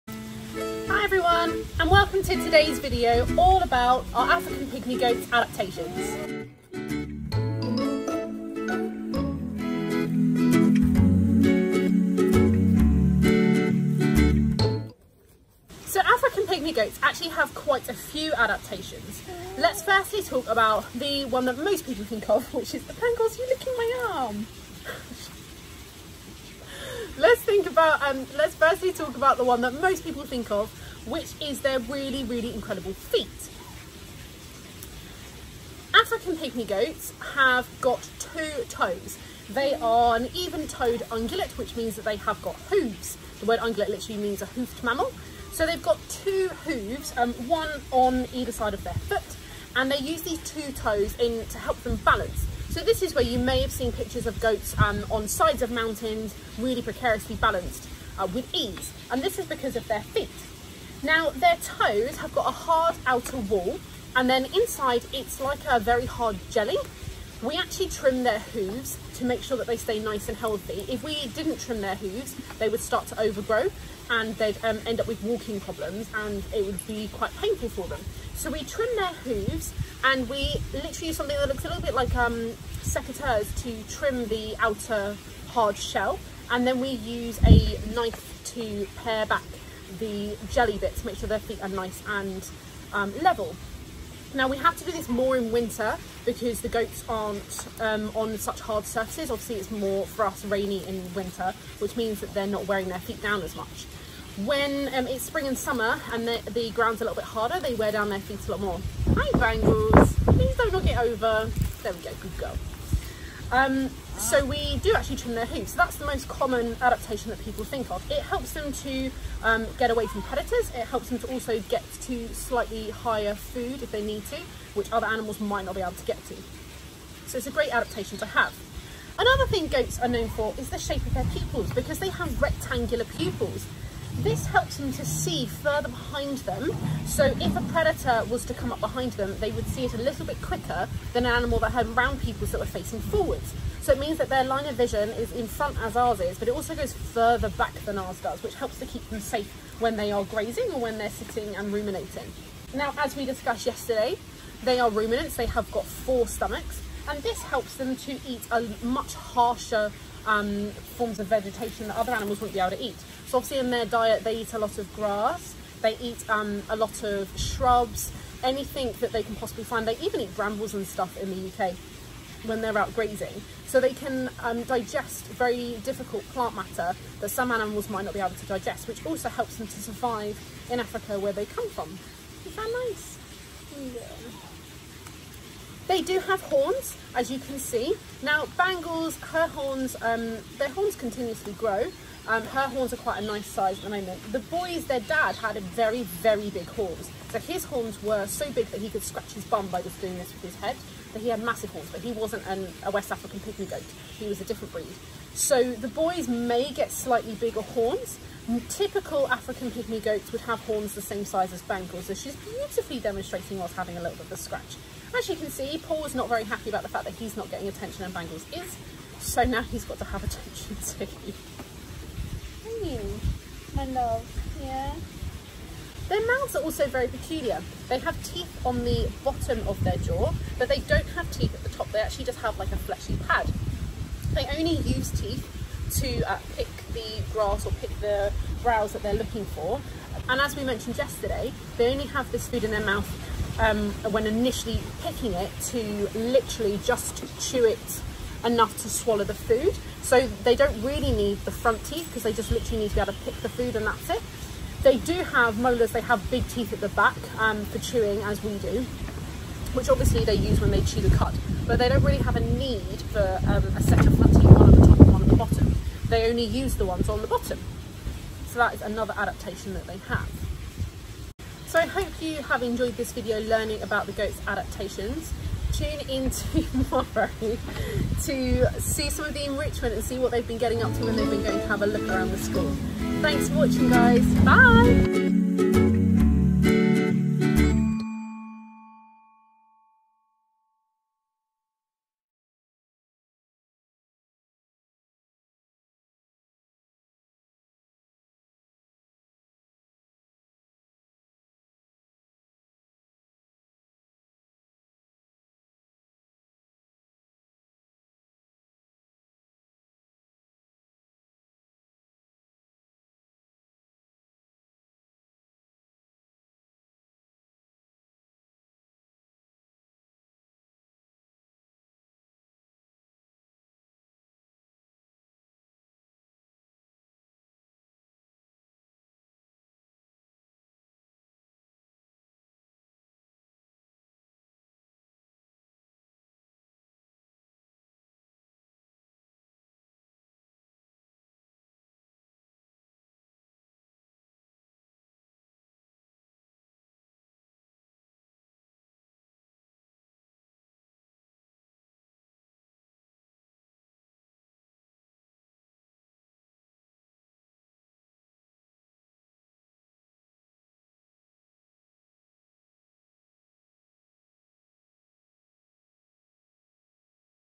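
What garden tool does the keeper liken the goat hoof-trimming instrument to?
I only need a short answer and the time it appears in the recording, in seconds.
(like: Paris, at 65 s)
secateurs, at 82 s.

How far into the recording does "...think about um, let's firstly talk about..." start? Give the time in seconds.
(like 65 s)
27 s.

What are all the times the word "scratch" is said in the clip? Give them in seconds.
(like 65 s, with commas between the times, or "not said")
199 s, 214 s.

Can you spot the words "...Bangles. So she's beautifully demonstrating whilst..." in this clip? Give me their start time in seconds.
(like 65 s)
211 s.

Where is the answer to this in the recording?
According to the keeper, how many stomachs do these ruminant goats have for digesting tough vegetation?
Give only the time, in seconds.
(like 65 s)
155 s.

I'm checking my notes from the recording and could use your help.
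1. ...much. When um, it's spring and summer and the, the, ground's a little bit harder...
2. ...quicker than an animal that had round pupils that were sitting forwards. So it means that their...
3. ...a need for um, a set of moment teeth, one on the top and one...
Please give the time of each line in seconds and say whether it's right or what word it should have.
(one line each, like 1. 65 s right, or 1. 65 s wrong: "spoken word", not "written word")
1. 103 s right
2. 140 s wrong: "facing", not "sitting"
3. 262 s wrong: "front", not "moment".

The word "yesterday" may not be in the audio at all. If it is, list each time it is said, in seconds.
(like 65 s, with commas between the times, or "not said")
153 s, 240 s.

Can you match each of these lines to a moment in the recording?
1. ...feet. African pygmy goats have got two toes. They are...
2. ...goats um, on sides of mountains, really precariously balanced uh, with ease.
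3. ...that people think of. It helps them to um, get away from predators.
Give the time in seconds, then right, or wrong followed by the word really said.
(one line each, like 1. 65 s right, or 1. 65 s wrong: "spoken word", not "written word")
1. 32 s right
2. 54 s right
3. 117 s right.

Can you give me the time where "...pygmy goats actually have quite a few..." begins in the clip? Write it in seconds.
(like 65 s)
16 s.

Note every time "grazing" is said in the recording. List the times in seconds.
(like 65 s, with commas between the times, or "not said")
150 s, 172 s.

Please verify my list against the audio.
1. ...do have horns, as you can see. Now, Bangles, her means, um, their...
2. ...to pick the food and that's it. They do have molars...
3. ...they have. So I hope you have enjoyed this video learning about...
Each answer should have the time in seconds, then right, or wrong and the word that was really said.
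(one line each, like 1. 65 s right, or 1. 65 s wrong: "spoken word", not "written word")
1. 186 s wrong: "horns", not "means"
2. 253 s right
3. 269 s right.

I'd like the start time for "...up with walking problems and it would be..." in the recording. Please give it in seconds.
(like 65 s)
74 s.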